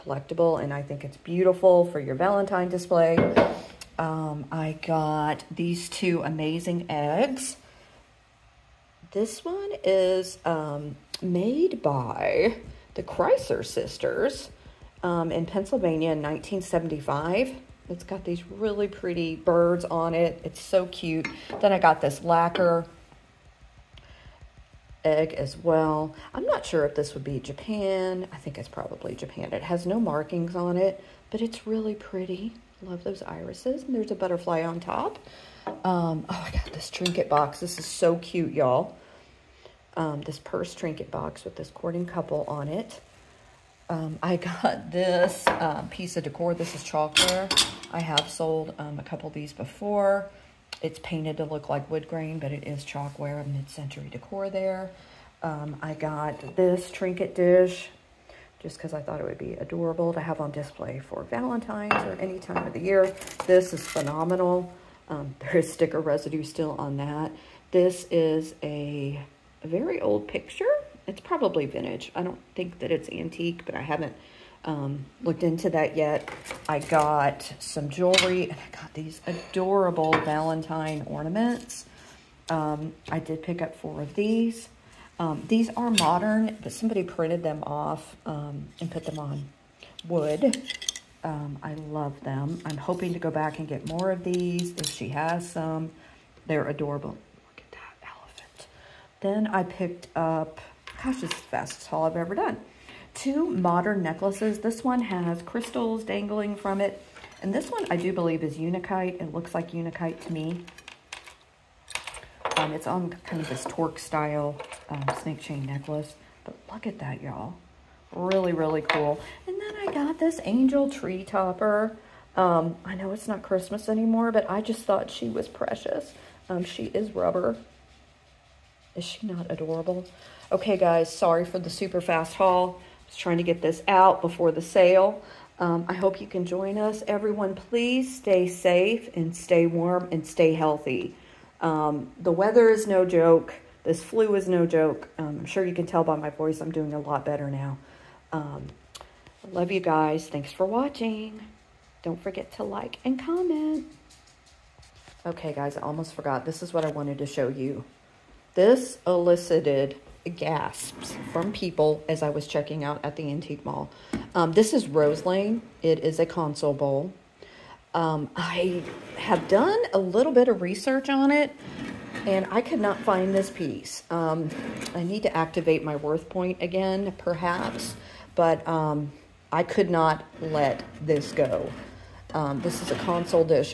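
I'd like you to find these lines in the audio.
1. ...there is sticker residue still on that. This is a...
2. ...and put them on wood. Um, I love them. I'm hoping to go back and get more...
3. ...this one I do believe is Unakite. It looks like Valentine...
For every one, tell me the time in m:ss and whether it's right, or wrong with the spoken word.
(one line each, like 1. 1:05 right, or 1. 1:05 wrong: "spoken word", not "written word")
1. 1:05 right
2. 1:28 right
3. 1:47 wrong: "Unakite", not "Valentine".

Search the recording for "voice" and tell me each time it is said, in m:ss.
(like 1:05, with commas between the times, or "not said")
2:26.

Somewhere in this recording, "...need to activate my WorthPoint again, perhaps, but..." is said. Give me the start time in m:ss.
2:55.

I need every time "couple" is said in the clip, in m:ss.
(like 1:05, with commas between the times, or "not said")
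0:42, 0:49.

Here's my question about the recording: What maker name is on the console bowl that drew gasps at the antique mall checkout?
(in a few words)
Roselane.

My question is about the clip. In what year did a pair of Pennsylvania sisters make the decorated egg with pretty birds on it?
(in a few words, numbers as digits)
1975.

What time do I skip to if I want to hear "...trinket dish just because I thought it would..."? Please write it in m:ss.
0:56.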